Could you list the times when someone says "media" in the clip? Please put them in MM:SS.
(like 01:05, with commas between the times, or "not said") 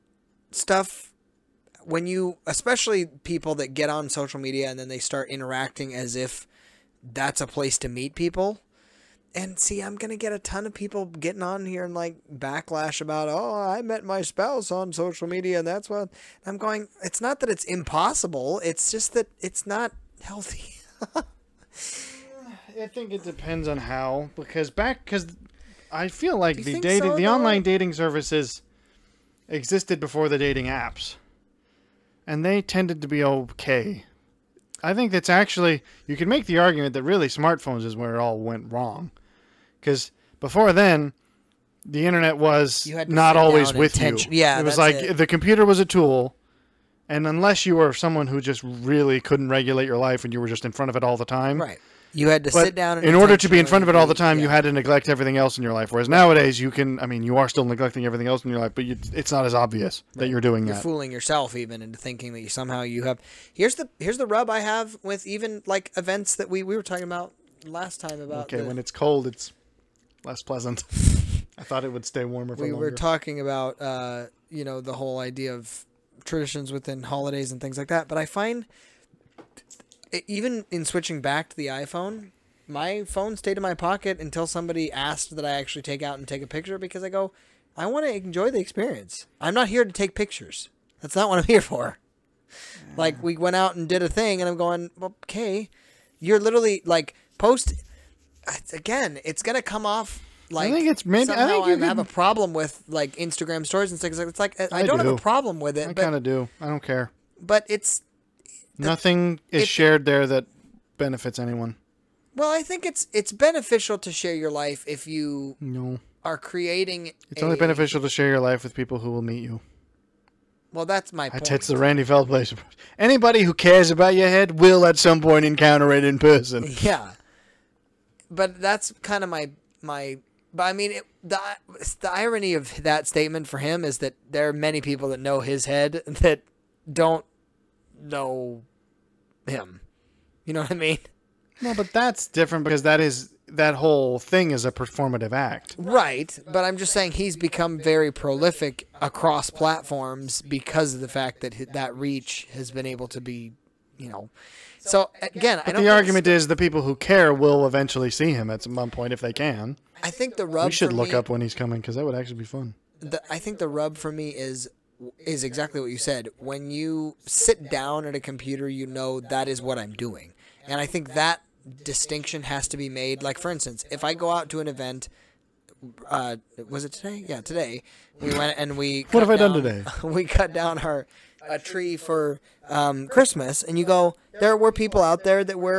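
00:04, 00:15.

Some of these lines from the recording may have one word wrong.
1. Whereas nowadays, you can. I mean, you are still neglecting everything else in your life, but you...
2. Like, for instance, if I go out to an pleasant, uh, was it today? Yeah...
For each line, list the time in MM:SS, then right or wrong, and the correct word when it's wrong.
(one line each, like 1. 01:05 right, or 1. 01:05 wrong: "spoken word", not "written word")
1. 00:55 right
2. 02:53 wrong: "event", not "pleasant".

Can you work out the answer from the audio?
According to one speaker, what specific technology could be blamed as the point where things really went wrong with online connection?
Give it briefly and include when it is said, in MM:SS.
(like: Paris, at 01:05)
smartphones, at 00:37.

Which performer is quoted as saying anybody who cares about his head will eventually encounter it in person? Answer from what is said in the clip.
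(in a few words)
Randy Feltface.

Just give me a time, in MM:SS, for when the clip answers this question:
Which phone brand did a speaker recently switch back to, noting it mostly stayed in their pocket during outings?
01:21.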